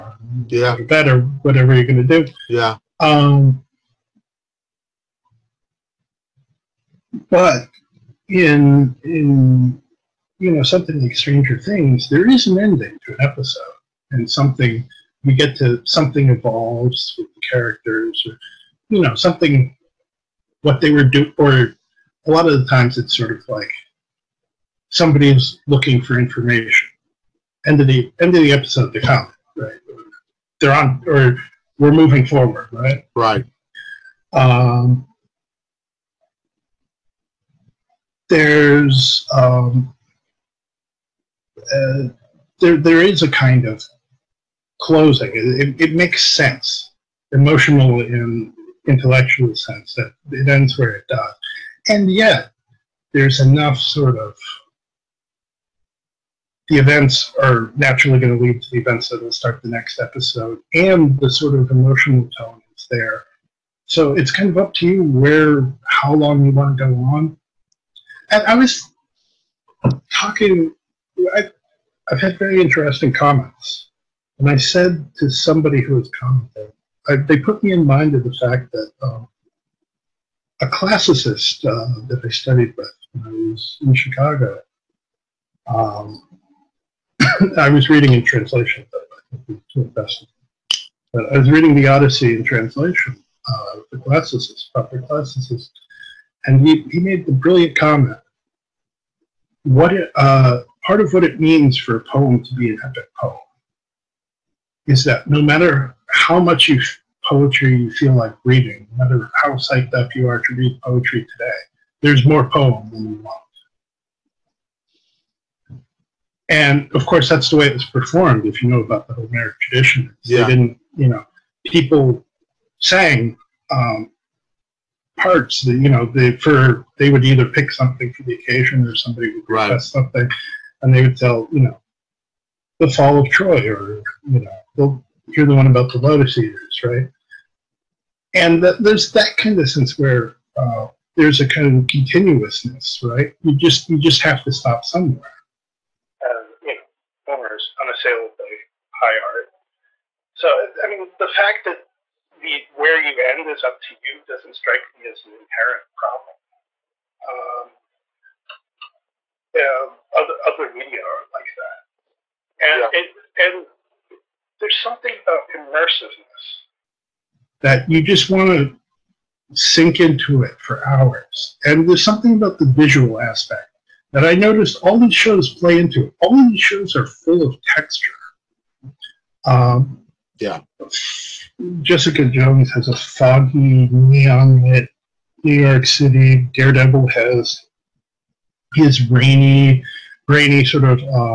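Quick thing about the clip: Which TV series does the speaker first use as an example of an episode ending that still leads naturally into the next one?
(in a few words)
Stranger Things.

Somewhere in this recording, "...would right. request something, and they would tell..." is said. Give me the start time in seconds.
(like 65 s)
129 s.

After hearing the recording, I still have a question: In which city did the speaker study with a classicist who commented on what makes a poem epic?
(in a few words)
Chicago.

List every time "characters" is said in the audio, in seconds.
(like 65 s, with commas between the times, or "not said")
17 s.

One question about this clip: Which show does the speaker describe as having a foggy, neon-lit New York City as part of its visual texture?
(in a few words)
Jessica Jones.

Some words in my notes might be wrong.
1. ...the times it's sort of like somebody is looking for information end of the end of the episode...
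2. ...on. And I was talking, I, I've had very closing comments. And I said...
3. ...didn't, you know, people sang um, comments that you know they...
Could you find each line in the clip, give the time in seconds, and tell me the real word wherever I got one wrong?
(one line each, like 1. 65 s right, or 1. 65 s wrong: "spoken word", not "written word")
1. 22 s right
2. 66 s wrong: "interesting", not "closing"
3. 120 s wrong: "parts", not "comments".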